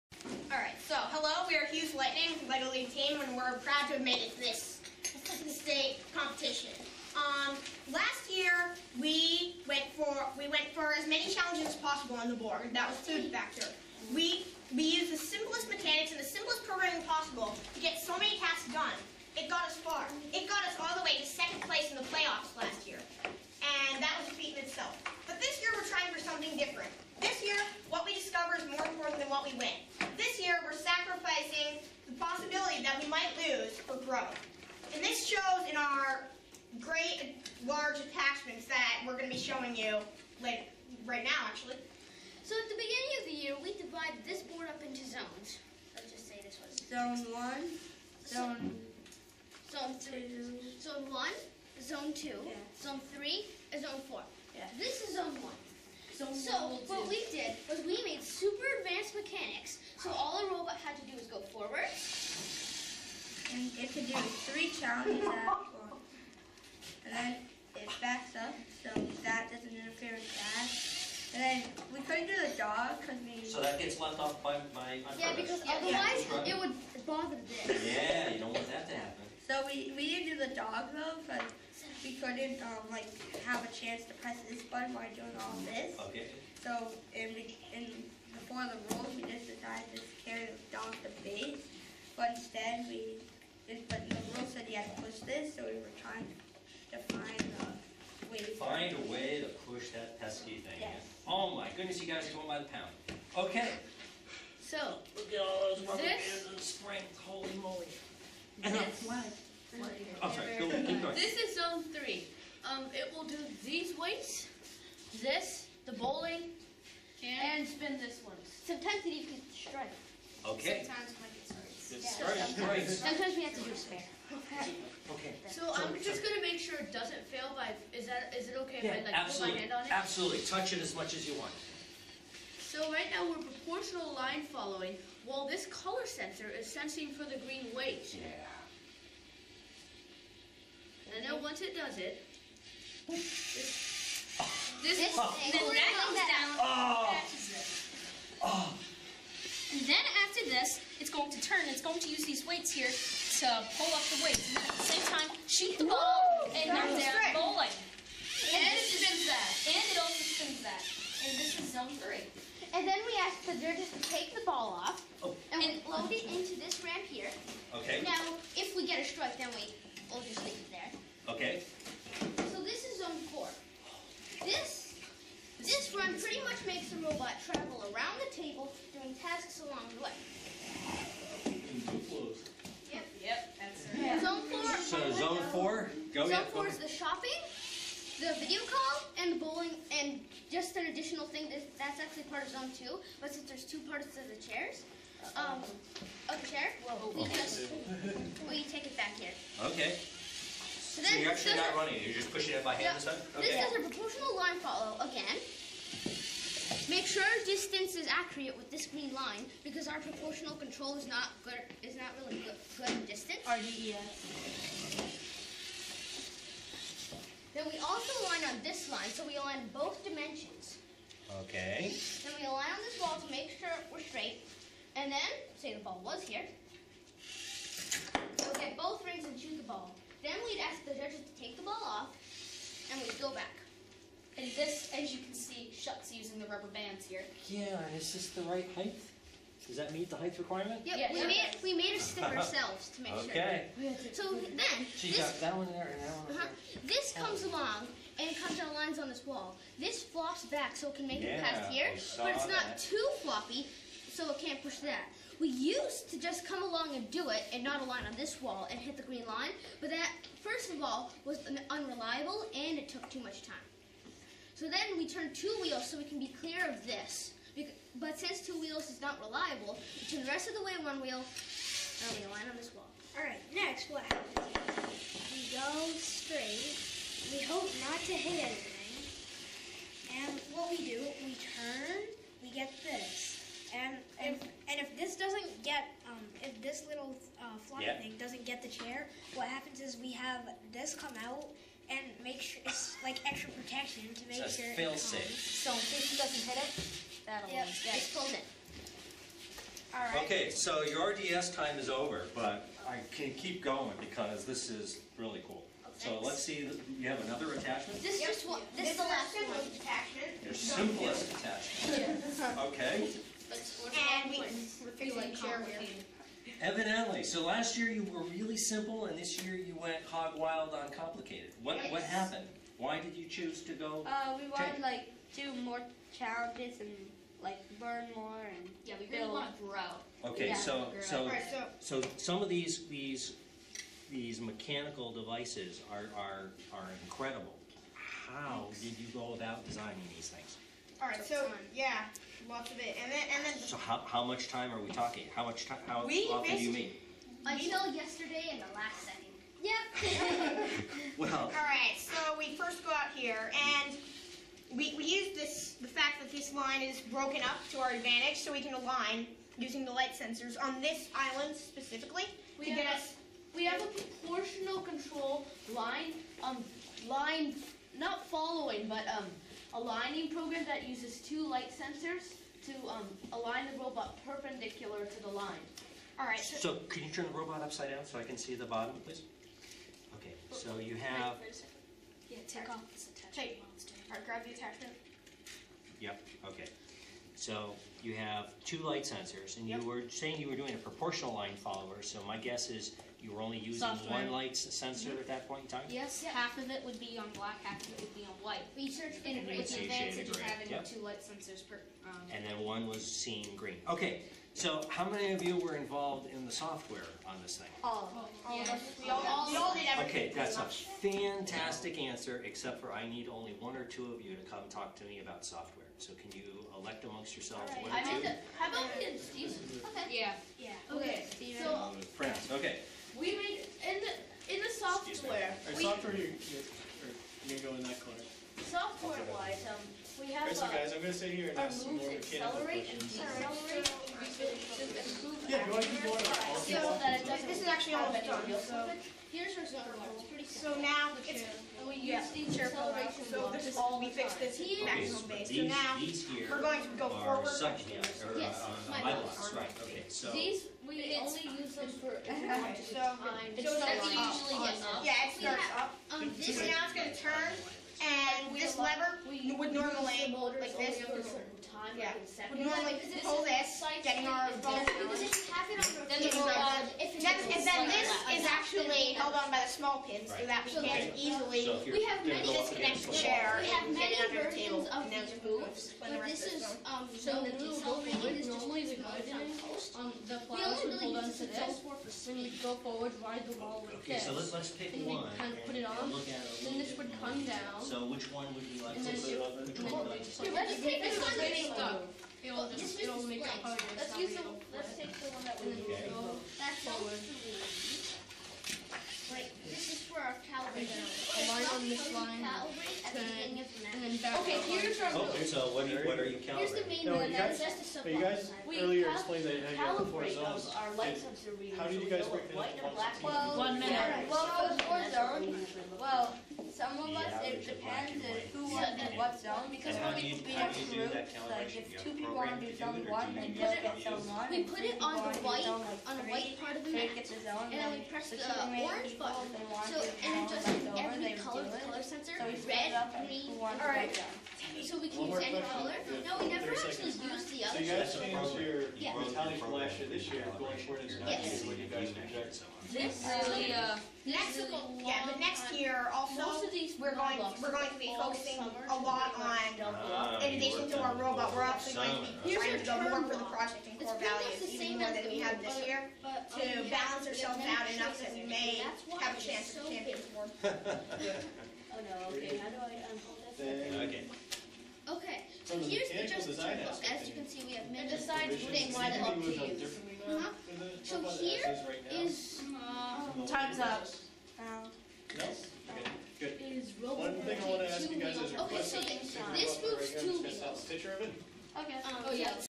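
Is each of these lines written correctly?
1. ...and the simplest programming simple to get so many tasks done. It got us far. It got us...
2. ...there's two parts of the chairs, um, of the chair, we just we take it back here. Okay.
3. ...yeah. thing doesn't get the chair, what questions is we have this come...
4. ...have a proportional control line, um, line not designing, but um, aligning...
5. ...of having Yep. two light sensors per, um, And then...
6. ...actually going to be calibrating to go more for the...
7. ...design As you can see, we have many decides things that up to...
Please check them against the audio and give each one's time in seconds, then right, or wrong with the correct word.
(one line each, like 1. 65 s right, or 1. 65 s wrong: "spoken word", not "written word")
1. 16 s wrong: "possible", not "simple"
2. 193 s right
3. 287 s wrong: "happens", not "questions"
4. 363 s wrong: "following", not "designing"
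5. 400 s right
6. 551 s wrong: "trying", not "calibrating"
7. 566 s right.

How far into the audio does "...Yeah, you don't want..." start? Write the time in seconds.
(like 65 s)
77 s.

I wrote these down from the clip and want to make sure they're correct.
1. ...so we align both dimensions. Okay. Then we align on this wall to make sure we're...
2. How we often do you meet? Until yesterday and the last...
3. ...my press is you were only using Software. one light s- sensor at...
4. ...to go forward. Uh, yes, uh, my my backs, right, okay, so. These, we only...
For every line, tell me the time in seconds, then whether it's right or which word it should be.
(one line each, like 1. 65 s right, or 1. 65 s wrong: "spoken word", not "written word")
1. 219 s right
2. 345 s right
3. 392 s wrong: "guess", not "press"
4. 446 s wrong: "blocks", not "backs".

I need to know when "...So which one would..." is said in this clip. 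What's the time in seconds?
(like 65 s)
487 s.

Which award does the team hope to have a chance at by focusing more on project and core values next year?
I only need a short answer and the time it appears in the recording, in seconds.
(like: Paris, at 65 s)
Champions Award, at 559 s.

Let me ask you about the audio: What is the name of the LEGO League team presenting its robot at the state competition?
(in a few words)
HUES Lightning.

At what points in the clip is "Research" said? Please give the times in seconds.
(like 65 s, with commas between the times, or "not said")
398 s.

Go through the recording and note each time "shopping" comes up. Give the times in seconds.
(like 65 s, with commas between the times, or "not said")
186 s.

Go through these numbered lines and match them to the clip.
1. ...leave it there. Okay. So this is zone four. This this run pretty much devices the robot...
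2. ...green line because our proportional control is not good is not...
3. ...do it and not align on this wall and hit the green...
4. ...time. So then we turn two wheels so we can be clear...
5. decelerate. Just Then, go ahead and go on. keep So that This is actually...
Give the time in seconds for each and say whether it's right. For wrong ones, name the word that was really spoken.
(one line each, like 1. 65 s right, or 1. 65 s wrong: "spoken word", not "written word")
1. 170 s wrong: "makes", not "devices"
2. 208 s right
3. 257 s right
4. 263 s right
5. 433 s wrong: "Yeah", not "Then".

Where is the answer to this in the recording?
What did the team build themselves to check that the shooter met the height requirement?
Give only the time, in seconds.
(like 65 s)
241 s.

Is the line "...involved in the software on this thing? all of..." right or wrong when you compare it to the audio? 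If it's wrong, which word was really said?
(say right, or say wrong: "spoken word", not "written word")
right.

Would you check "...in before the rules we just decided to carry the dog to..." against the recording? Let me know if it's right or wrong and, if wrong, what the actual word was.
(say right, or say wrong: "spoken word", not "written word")
right.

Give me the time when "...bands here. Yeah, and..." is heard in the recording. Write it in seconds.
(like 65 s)
236 s.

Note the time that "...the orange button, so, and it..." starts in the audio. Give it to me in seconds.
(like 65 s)
528 s.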